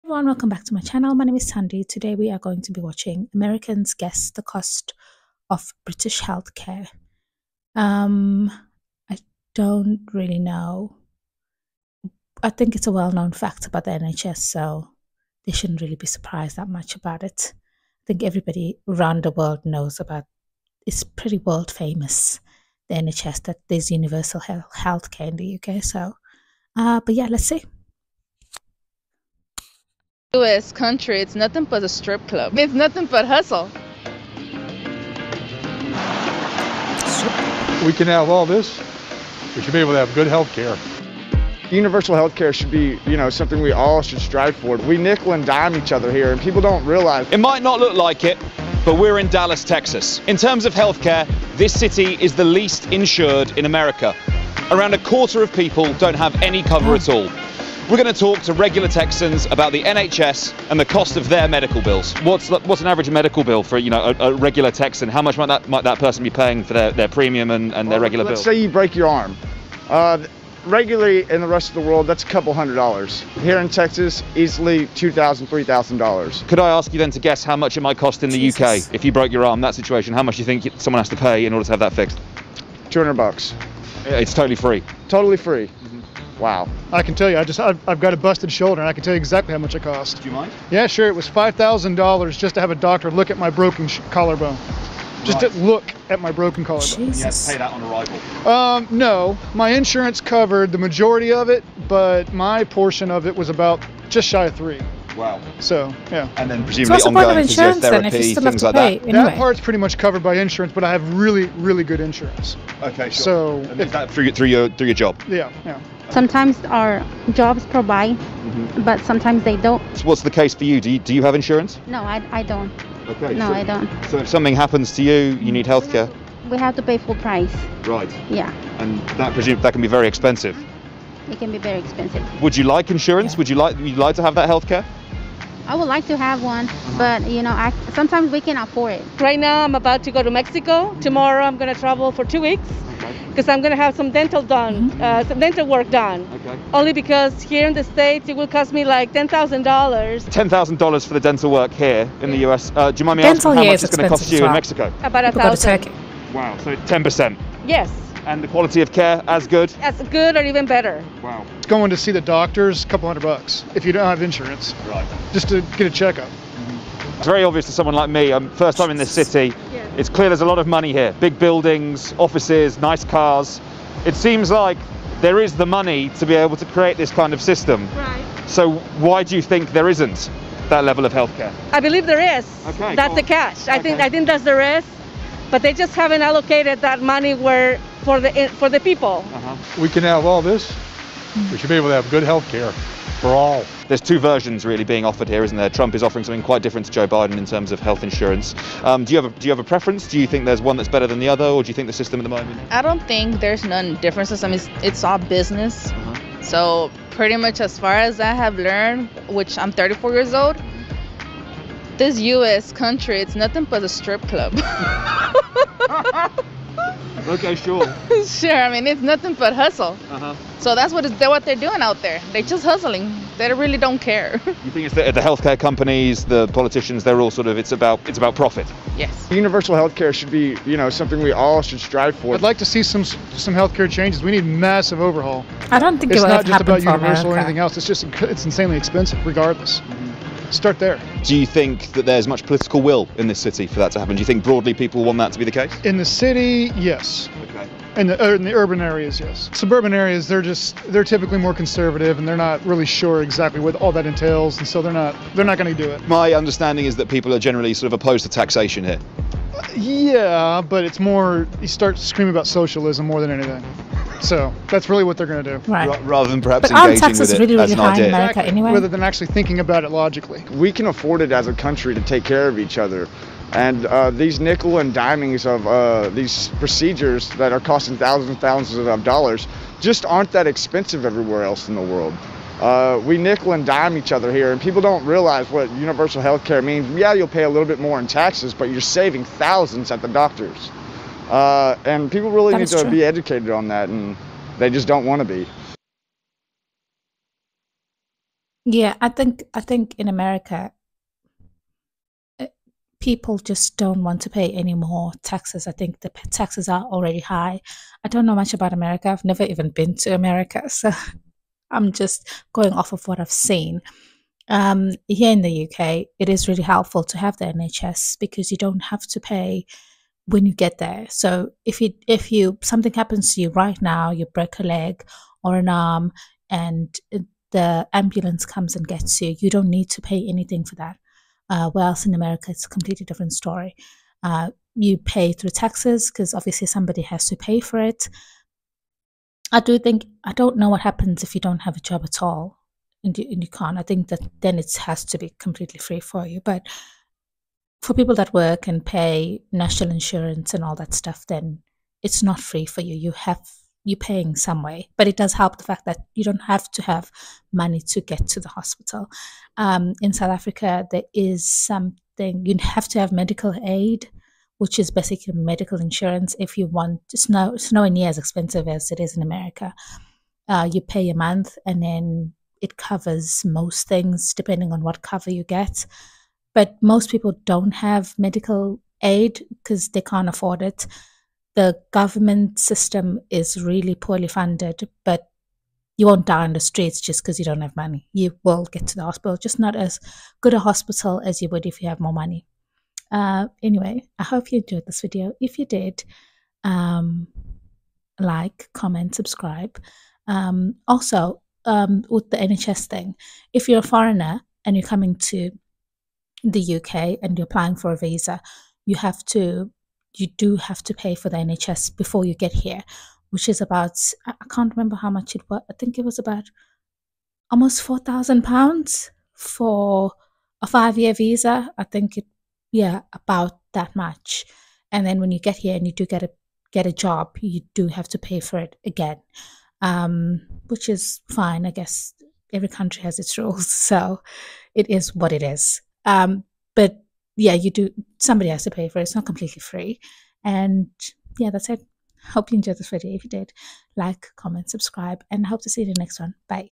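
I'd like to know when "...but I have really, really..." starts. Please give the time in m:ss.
1:50.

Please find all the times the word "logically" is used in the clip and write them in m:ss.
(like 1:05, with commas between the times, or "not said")
4:29.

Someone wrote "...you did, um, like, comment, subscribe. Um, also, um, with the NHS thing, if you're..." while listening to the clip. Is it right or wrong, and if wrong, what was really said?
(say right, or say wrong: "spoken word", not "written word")
right.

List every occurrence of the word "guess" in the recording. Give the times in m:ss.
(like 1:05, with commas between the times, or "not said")
0:03, 1:17, 7:11.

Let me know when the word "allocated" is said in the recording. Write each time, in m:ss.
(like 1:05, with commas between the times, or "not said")
3:06.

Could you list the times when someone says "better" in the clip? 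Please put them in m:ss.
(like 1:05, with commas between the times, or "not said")
2:40, 3:20.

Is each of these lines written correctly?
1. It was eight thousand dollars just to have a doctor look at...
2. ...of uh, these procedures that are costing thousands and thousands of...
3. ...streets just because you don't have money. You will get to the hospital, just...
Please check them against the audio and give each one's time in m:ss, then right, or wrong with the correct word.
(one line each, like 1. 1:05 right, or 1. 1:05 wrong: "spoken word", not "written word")
1. 1:31 wrong: "five", not "eight"
2. 4:35 right
3. 6:26 right.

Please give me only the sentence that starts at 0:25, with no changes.
So, uh, but yeah, let's see.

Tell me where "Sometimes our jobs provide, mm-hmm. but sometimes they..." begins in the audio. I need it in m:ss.
1:56.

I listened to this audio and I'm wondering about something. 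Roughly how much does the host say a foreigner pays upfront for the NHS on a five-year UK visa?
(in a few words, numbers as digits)
almost £4,000.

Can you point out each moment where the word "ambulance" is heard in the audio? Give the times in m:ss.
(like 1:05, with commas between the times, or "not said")
5:27.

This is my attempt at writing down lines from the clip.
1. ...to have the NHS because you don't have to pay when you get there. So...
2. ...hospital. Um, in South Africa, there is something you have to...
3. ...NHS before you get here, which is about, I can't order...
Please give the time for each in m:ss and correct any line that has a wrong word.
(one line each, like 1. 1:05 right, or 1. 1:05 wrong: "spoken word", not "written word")
1. 5:17 right
2. 5:58 right
3. 6:51 wrong: "remember", not "order".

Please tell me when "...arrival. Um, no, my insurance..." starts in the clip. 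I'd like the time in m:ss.
1:37.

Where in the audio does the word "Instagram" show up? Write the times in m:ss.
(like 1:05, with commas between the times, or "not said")
not said.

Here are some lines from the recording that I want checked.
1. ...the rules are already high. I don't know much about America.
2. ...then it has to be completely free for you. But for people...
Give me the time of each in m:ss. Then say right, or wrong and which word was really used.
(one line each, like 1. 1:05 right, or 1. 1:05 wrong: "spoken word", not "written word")
1. 5:05 wrong: "taxes", not "rules"
2. 5:44 right.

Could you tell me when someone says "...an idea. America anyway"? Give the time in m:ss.
4:27.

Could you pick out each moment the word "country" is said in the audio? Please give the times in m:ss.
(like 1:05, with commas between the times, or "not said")
0:30, 3:32, 4:31, 7:12.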